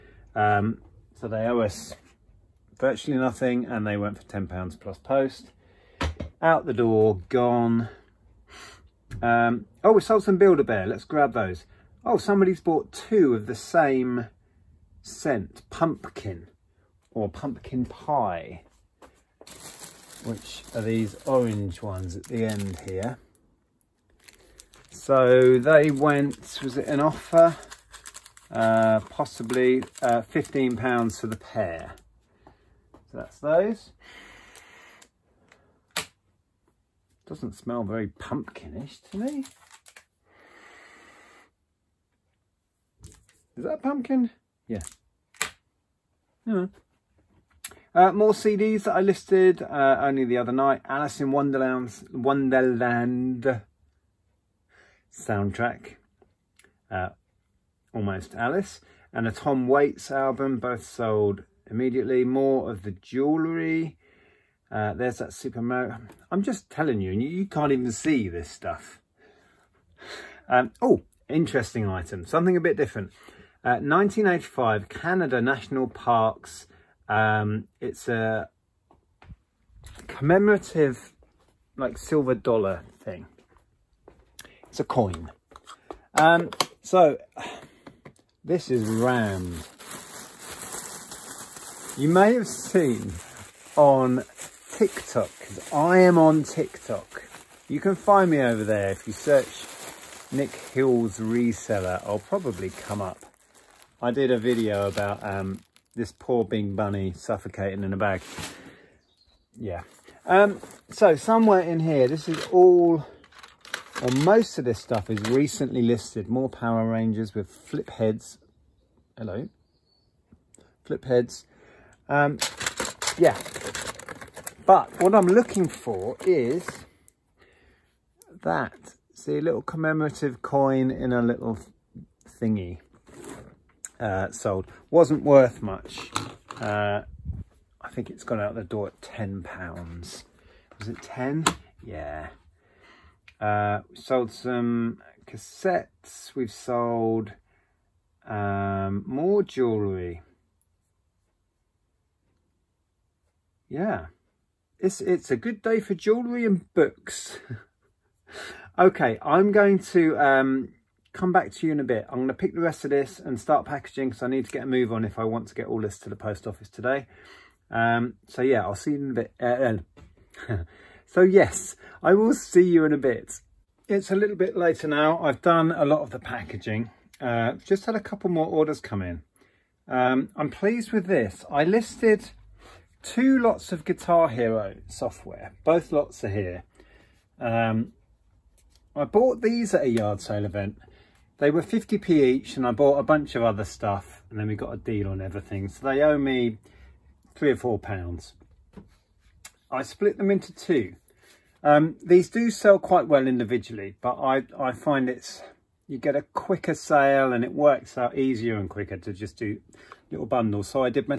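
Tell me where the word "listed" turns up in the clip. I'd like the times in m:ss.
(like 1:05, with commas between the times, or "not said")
0:49, 1:55, 3:01.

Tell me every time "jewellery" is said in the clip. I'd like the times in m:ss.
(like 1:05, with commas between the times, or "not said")
1:02, 2:29, 2:35.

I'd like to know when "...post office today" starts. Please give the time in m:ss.
2:46.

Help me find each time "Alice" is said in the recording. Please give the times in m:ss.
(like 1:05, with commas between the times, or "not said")
0:50, 0:58.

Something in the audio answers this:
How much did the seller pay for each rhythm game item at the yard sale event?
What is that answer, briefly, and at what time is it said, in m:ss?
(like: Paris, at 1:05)
50p, at 3:11.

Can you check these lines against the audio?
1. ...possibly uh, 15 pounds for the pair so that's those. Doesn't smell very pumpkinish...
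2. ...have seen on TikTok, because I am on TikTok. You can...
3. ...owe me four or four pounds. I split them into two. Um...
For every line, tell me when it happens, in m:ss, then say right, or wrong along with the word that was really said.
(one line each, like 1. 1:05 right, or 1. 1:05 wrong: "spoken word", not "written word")
1. 0:29 right
2. 1:32 right
3. 3:16 wrong: "three", not "four".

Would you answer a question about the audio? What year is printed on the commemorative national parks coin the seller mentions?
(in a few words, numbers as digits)
1985.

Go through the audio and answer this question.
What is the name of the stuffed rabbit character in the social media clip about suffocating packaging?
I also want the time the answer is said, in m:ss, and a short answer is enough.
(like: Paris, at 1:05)
Bing Bunny, at 1:46.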